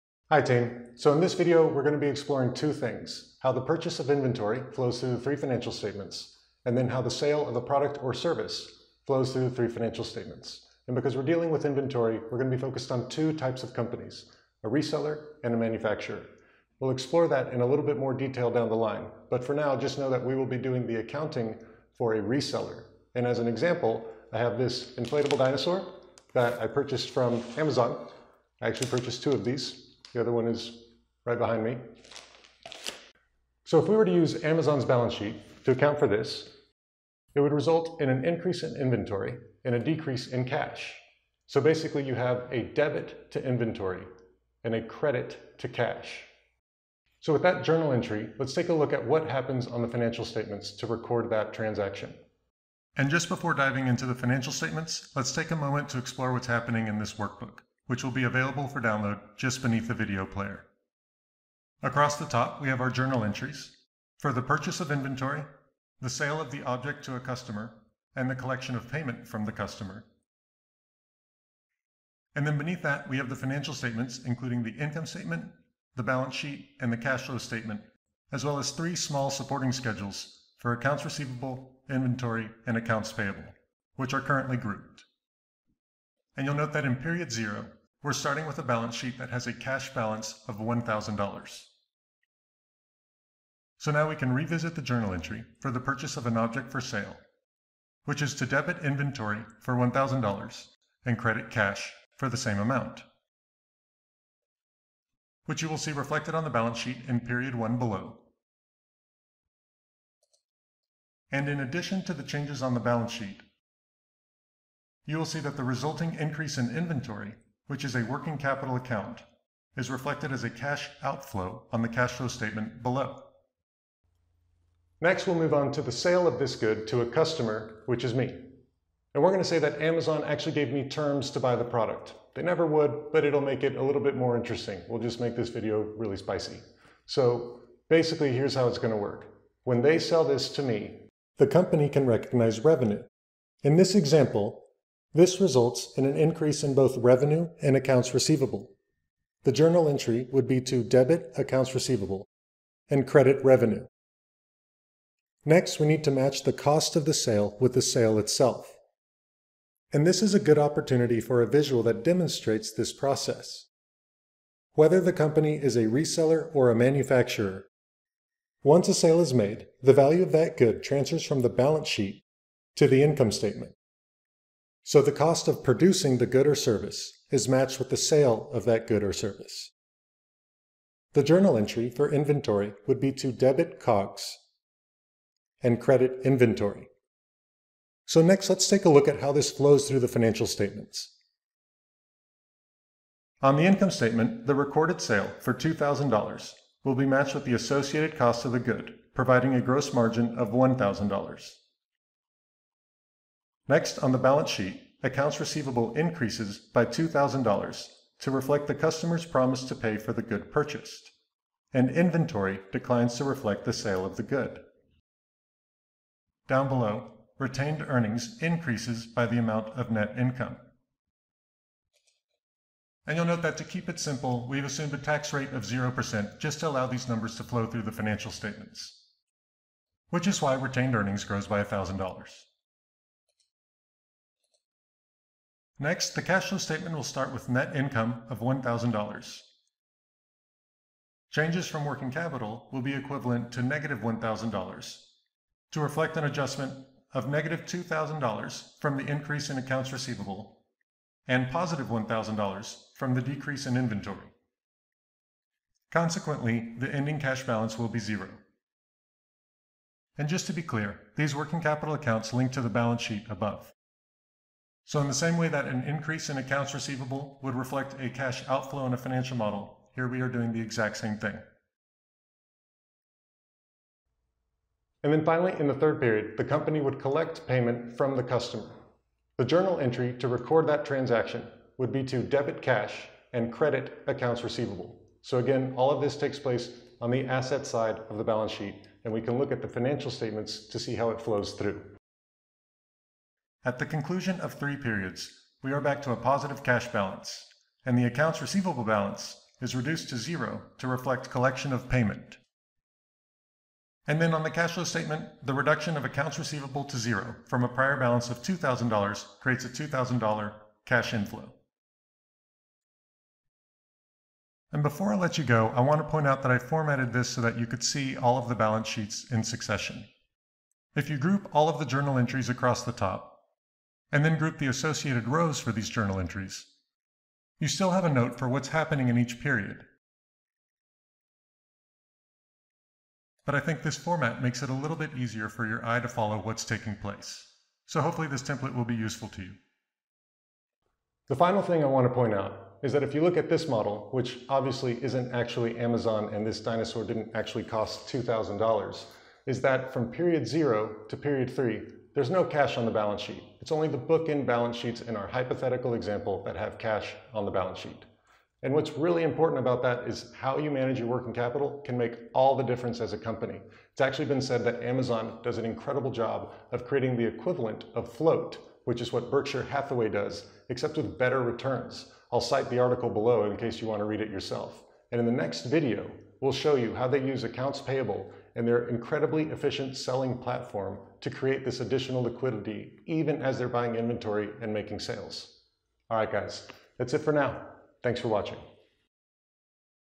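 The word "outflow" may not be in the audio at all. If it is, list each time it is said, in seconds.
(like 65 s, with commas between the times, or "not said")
121 s, 268 s.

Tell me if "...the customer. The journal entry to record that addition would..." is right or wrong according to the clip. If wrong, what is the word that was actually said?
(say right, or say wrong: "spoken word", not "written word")
wrong: "transaction", not "addition".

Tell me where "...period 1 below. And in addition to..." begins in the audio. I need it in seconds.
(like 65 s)
107 s.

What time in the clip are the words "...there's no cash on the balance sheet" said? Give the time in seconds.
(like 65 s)
352 s.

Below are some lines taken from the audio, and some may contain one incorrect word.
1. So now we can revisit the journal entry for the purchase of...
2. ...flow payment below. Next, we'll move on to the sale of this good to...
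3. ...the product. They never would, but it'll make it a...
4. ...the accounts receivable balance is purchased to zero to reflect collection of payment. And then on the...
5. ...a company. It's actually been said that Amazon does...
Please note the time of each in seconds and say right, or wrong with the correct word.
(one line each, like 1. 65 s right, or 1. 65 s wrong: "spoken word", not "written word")
1. 93 s right
2. 122 s wrong: "statement", not "payment"
3. 131 s right
4. 297 s wrong: "reduced", not "purchased"
5. 363 s right.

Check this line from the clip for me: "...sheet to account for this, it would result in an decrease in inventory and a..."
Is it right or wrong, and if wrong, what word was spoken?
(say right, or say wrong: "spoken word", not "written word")
wrong: "increase", not "decrease".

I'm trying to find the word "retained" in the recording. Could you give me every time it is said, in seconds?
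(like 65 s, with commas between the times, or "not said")
217 s, 230 s.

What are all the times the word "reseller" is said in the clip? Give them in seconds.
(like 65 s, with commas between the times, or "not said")
14 s, 22 s, 165 s.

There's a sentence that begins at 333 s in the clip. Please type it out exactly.
But I think this format makes it a little bit easier for your eye to follow what's taking place.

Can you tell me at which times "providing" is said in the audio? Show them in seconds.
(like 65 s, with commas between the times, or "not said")
199 s.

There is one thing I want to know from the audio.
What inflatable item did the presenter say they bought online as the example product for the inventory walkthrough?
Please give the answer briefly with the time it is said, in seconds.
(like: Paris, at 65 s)
Inflatable dinosaur, at 24 s.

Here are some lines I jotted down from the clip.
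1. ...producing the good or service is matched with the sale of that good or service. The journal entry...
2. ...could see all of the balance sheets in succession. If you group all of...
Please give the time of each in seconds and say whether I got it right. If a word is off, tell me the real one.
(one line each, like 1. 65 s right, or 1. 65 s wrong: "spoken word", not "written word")
1. 175 s right
2. 317 s right.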